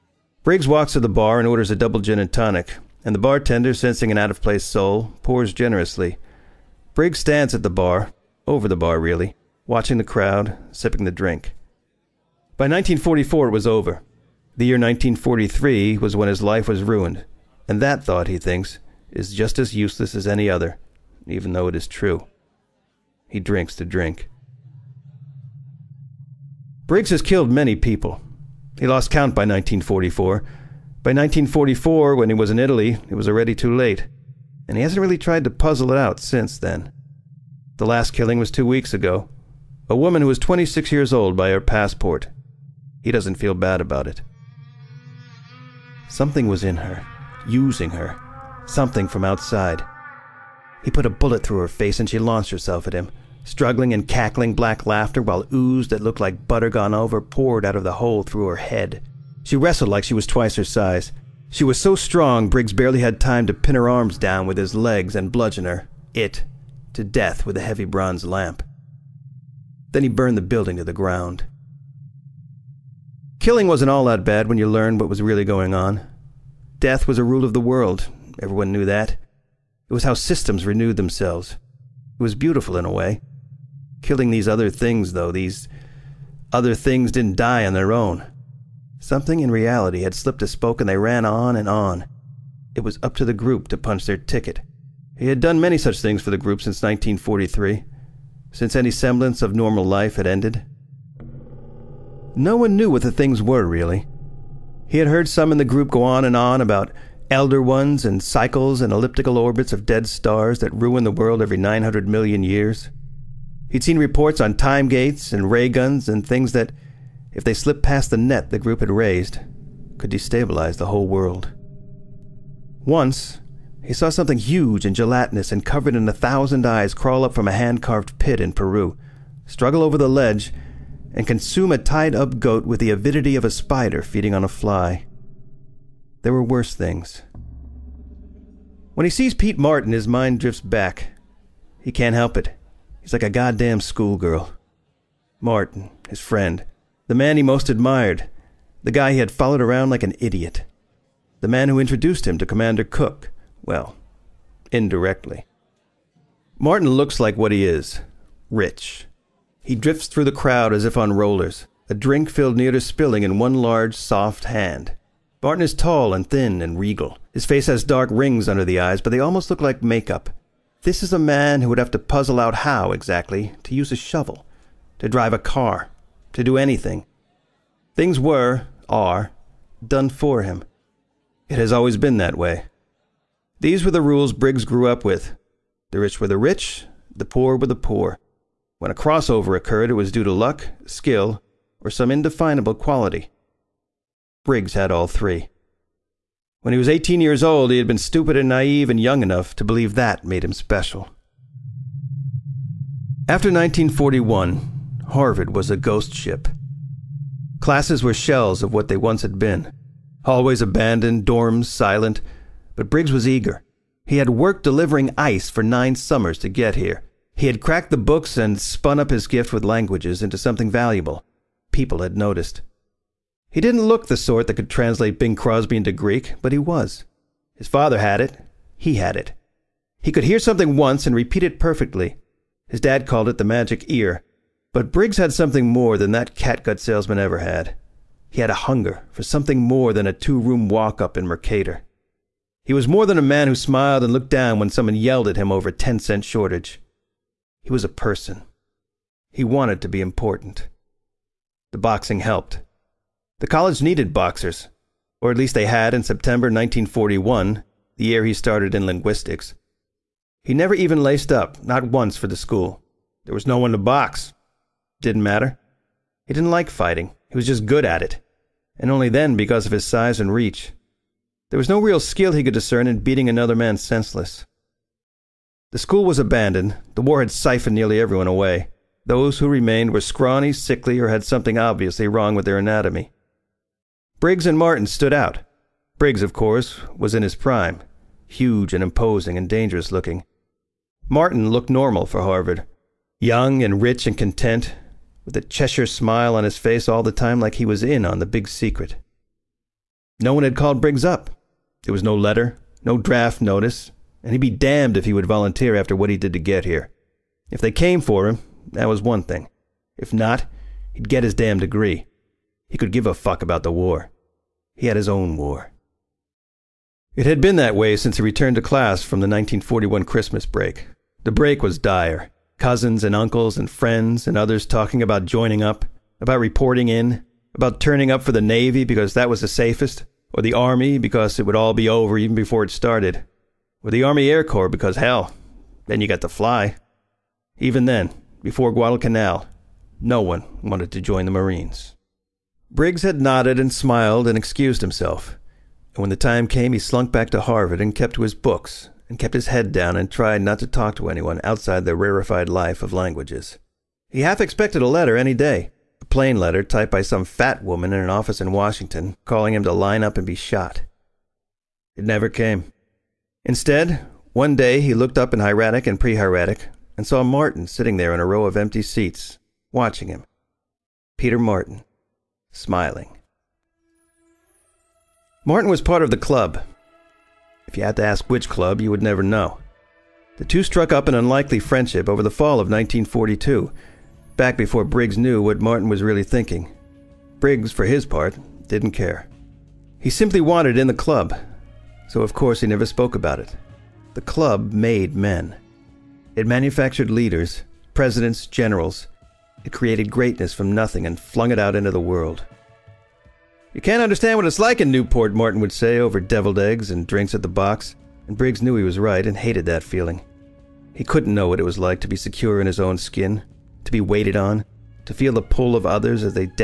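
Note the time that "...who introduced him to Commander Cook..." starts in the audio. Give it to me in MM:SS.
02:31.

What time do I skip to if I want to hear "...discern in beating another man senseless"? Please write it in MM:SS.
04:32.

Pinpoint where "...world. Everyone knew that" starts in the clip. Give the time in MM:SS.
01:17.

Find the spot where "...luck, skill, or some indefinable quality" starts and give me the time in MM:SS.
03:10.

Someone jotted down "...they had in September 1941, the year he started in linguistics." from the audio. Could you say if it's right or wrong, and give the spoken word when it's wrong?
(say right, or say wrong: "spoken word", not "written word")
right.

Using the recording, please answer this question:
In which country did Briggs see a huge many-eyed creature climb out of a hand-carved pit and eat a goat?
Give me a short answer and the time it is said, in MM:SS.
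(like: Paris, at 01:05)
Peru, at 02:08.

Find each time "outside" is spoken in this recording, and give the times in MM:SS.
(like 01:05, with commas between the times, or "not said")
00:49, 05:51.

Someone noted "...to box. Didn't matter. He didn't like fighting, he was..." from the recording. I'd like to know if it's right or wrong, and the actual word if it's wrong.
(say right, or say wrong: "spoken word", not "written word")
right.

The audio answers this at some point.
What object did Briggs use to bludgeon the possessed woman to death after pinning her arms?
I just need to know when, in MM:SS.
01:07.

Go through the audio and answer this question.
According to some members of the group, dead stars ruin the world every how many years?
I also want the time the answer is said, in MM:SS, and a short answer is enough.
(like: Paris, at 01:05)
900 million, at 01:51.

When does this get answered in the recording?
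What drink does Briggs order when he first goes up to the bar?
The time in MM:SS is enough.
00:01.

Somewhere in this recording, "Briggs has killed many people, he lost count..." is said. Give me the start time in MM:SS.
00:26.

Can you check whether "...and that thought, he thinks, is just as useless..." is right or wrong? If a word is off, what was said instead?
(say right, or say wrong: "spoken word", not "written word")
right.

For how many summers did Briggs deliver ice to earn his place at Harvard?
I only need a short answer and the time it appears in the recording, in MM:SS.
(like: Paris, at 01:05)
9, at 03:35.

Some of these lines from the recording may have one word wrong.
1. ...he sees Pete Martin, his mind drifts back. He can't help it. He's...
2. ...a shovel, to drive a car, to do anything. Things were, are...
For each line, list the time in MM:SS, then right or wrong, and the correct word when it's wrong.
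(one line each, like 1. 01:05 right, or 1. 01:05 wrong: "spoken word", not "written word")
1. 02:19 right
2. 02:53 right.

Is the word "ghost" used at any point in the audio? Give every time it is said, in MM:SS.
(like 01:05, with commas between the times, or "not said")
03:25.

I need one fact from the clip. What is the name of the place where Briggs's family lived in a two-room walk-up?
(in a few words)
Mercator.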